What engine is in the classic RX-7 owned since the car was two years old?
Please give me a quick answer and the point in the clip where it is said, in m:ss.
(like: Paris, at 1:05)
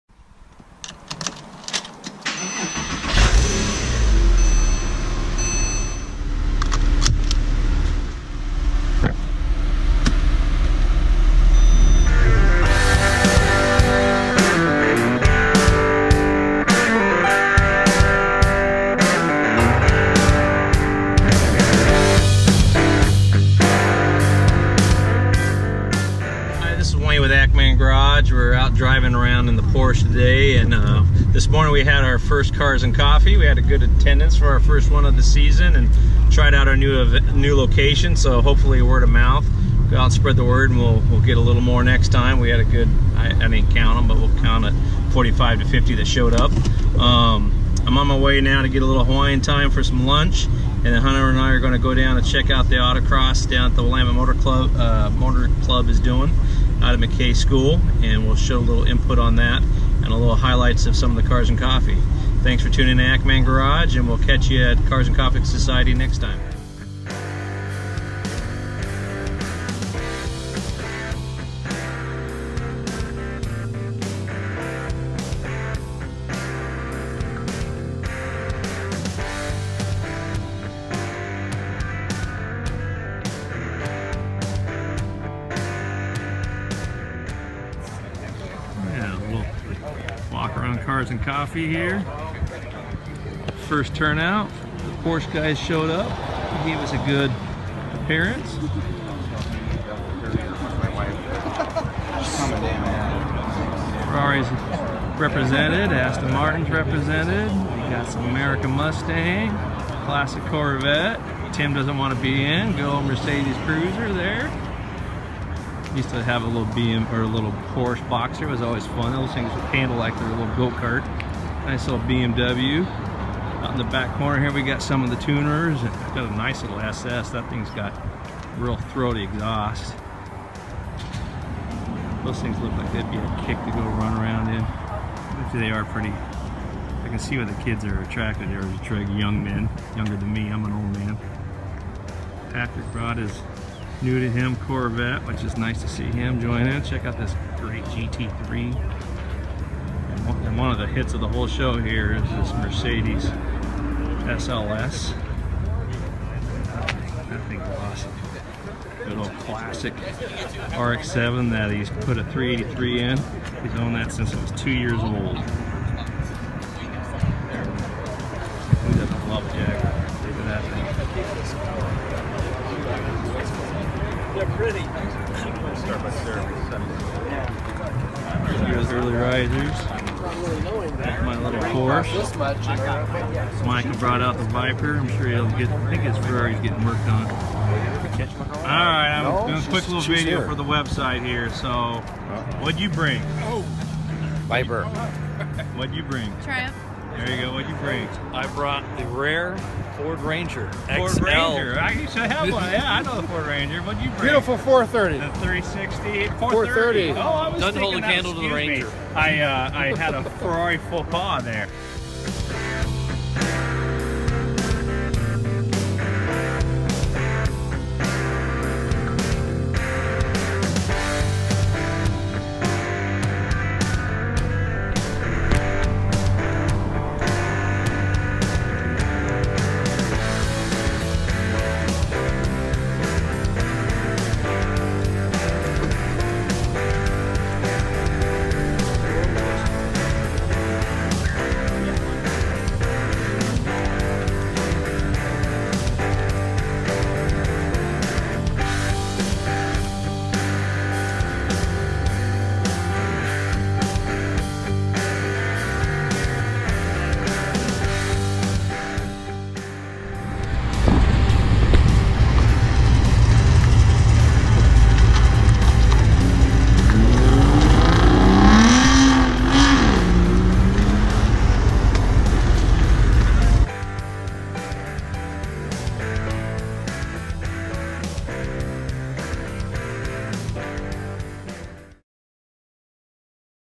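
383, at 2:42.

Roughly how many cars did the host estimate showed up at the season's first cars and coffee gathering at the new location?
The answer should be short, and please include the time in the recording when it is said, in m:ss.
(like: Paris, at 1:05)
45 to 50, at 0:45.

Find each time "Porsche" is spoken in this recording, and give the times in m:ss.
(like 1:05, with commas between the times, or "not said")
0:29, 1:35, 1:57.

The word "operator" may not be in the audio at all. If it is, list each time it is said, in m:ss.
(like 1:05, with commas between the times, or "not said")
not said.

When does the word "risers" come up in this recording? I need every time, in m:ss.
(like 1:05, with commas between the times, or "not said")
2:59.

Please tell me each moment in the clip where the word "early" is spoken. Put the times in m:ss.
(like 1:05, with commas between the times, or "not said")
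2:58.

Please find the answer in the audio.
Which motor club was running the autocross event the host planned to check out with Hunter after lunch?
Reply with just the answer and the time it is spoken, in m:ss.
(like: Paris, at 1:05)
Willamette Motor Club, at 0:53.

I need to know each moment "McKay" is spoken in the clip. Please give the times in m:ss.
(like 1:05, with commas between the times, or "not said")
0:56.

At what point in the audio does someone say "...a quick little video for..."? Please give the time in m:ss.
3:09.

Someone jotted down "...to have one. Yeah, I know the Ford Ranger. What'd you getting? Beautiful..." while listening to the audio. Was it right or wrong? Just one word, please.
wrong.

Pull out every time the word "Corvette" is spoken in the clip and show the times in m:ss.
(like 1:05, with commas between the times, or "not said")
1:50, 2:24.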